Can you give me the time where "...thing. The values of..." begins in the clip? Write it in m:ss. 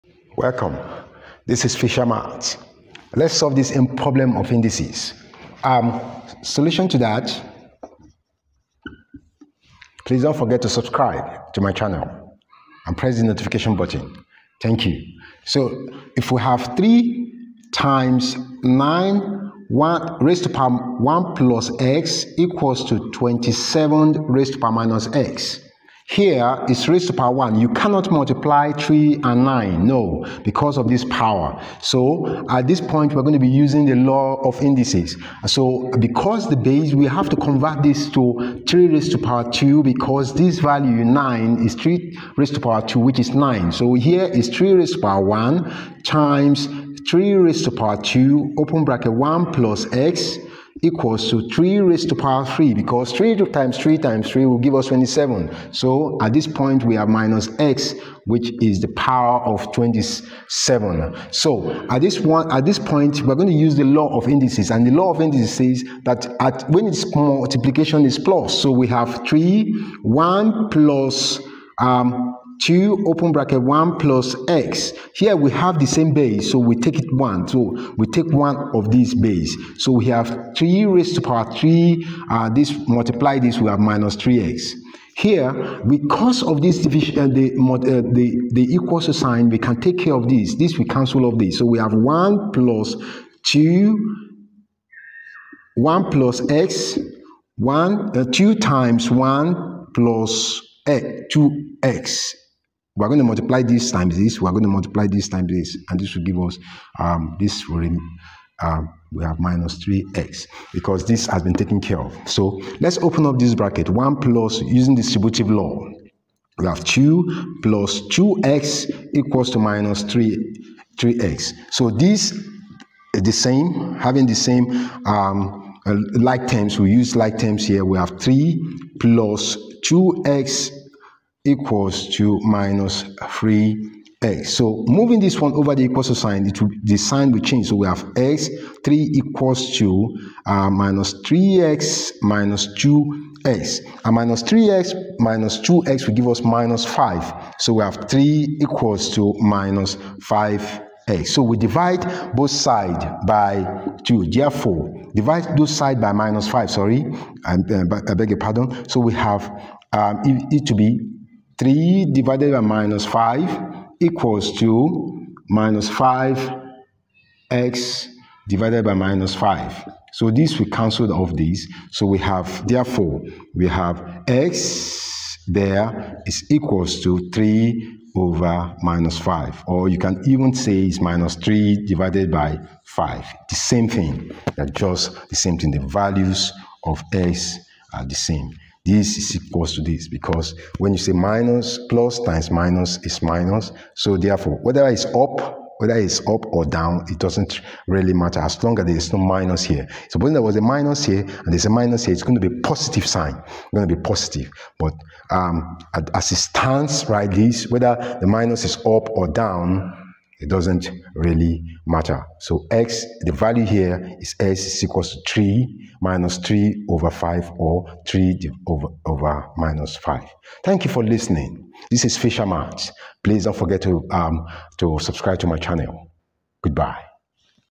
3:05.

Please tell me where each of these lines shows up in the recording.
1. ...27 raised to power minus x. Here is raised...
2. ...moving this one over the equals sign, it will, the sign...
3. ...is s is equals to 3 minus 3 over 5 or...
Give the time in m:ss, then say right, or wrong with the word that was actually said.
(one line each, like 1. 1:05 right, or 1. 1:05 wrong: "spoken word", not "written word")
1. 0:23 right
2. 2:14 right
3. 3:34 right.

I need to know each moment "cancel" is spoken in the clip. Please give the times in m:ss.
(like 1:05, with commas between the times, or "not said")
1:30, 2:50.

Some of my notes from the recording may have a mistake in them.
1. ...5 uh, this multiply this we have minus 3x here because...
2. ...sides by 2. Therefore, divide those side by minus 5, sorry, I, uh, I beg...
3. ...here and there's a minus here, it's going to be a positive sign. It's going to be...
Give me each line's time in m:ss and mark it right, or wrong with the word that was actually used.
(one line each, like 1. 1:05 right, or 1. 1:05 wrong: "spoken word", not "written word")
1. 1:21 wrong: "3", not "5"
2. 2:32 right
3. 3:21 right.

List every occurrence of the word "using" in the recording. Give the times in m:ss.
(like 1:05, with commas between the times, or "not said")
0:33, 1:54.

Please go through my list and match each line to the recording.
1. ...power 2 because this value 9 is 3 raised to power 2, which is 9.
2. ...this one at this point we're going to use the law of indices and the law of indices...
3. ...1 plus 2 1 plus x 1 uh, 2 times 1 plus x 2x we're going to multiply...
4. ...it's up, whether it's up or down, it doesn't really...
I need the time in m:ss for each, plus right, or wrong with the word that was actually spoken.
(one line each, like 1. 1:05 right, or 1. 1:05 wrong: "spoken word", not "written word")
1. 0:39 right
2. 1:02 right
3. 1:31 right
4. 3:14 right.